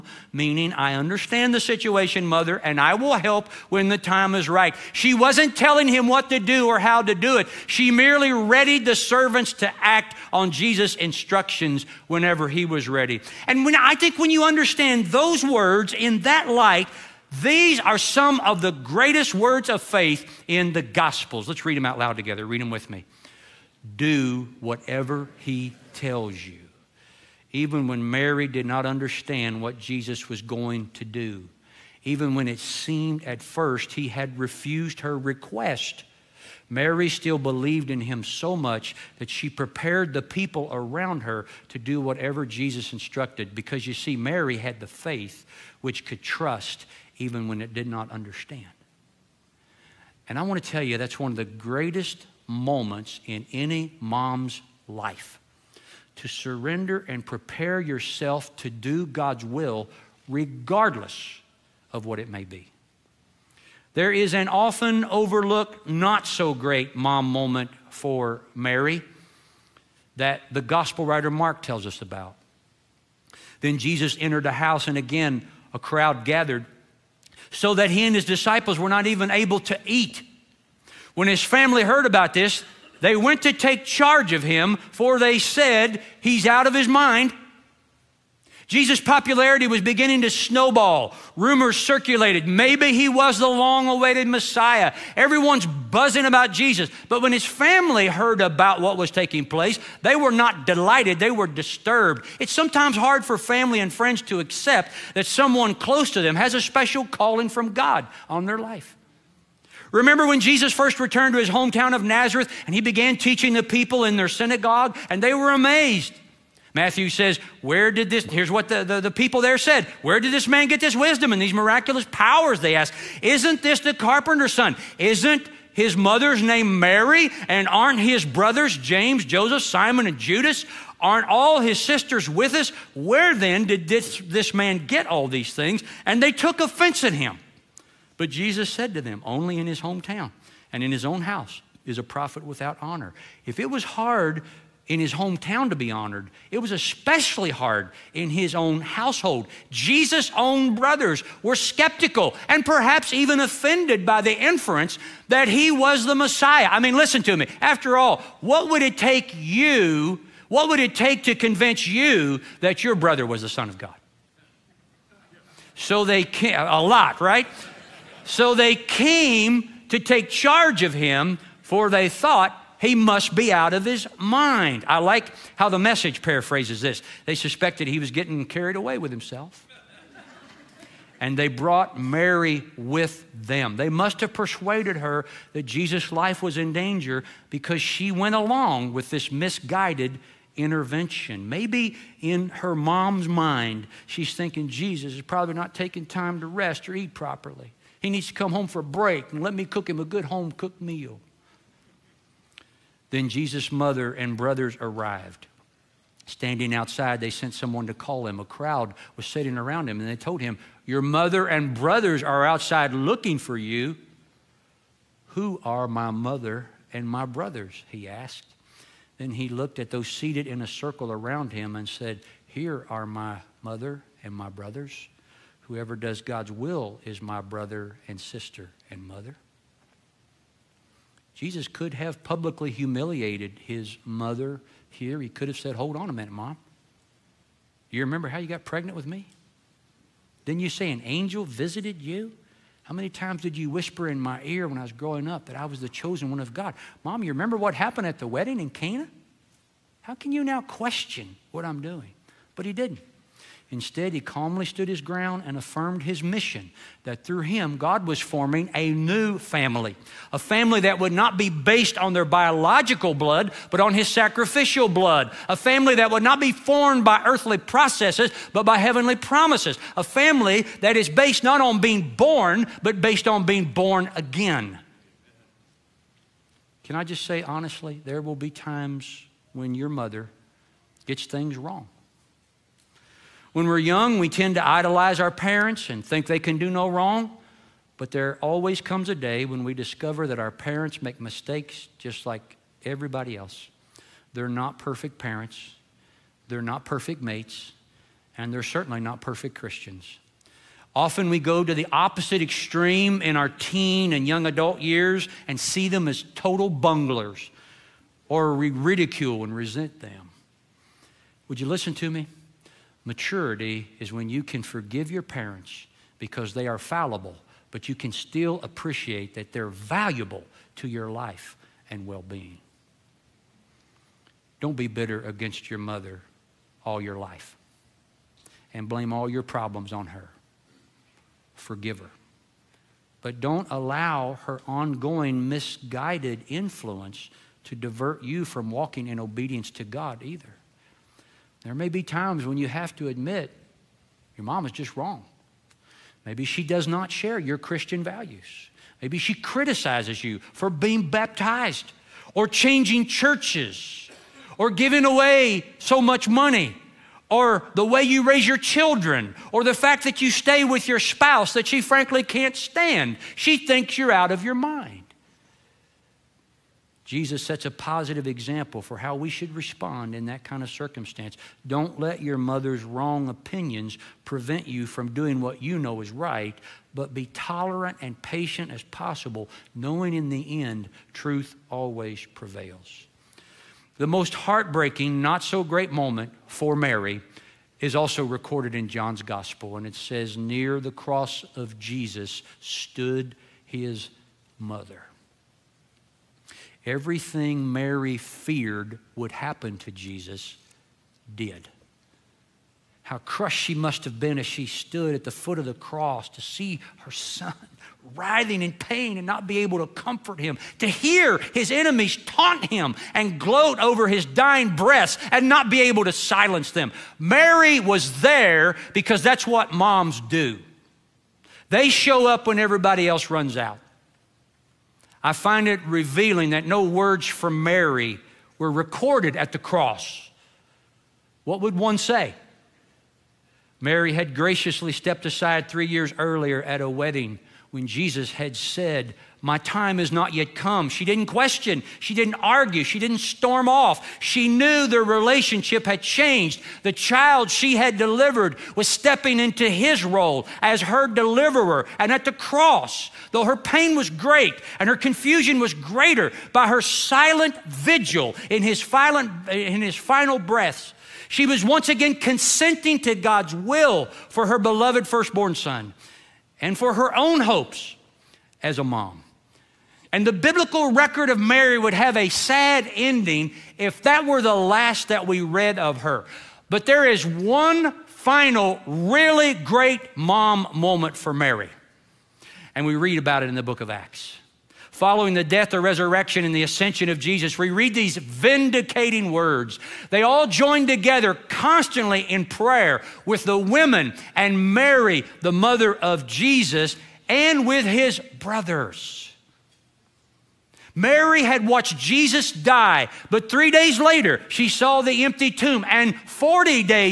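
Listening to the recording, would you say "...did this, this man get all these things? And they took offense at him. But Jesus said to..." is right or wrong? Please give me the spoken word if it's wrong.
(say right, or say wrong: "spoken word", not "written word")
right.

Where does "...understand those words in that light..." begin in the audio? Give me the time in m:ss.
0:14.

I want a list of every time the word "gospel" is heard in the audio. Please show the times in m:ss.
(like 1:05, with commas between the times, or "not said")
0:20, 1:10, 6:29.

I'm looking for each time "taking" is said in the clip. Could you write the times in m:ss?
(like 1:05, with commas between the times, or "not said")
1:39, 3:15.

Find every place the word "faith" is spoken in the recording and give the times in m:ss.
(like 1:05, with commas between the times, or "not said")
0:19, 0:44.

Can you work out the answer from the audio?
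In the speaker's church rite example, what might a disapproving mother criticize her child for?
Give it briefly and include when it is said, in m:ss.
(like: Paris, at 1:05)
Being baptized, at 5:50.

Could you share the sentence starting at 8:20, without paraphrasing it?
Mary had watched Jesus die, but three days later, she saw the empty tomb.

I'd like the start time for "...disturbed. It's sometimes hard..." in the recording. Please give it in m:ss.
1:41.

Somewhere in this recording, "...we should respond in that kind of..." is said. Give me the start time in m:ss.
6:09.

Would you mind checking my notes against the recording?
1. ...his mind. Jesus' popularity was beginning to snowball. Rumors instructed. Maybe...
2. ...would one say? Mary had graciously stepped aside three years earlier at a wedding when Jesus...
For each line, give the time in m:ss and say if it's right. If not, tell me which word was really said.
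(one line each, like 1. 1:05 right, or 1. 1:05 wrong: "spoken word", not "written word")
1. 1:26 wrong: "circulated", not "instructed"
2. 7:11 right.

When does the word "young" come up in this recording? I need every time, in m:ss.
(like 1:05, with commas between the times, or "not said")
4:43, 5:04.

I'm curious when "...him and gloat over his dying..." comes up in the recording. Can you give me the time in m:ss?
6:52.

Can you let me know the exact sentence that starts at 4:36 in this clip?
Can I just say honestly, there will be times when your mother gets things wrong.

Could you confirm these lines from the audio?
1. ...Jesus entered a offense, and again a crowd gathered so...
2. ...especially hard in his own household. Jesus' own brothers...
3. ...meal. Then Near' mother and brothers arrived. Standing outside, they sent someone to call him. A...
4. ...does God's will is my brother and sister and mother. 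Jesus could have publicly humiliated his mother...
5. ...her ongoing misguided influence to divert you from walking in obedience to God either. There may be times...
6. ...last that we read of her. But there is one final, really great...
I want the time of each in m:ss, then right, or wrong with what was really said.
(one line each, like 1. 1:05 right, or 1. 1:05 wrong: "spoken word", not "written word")
1. 1:13 wrong: "house", not "offense"
2. 2:26 right
3. 3:20 wrong: "Jesus", not "Near"
4. 3:45 right
5. 5:34 right
6. 7:54 right.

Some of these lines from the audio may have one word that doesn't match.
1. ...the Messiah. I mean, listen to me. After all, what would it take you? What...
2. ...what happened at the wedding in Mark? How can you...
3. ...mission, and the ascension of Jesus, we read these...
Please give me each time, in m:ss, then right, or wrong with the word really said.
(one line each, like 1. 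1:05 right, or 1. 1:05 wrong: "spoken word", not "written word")
1. 2:36 right
2. 4:07 wrong: "Cana", not "Mark"
3. 8:05 wrong: "resurrection", not "mission".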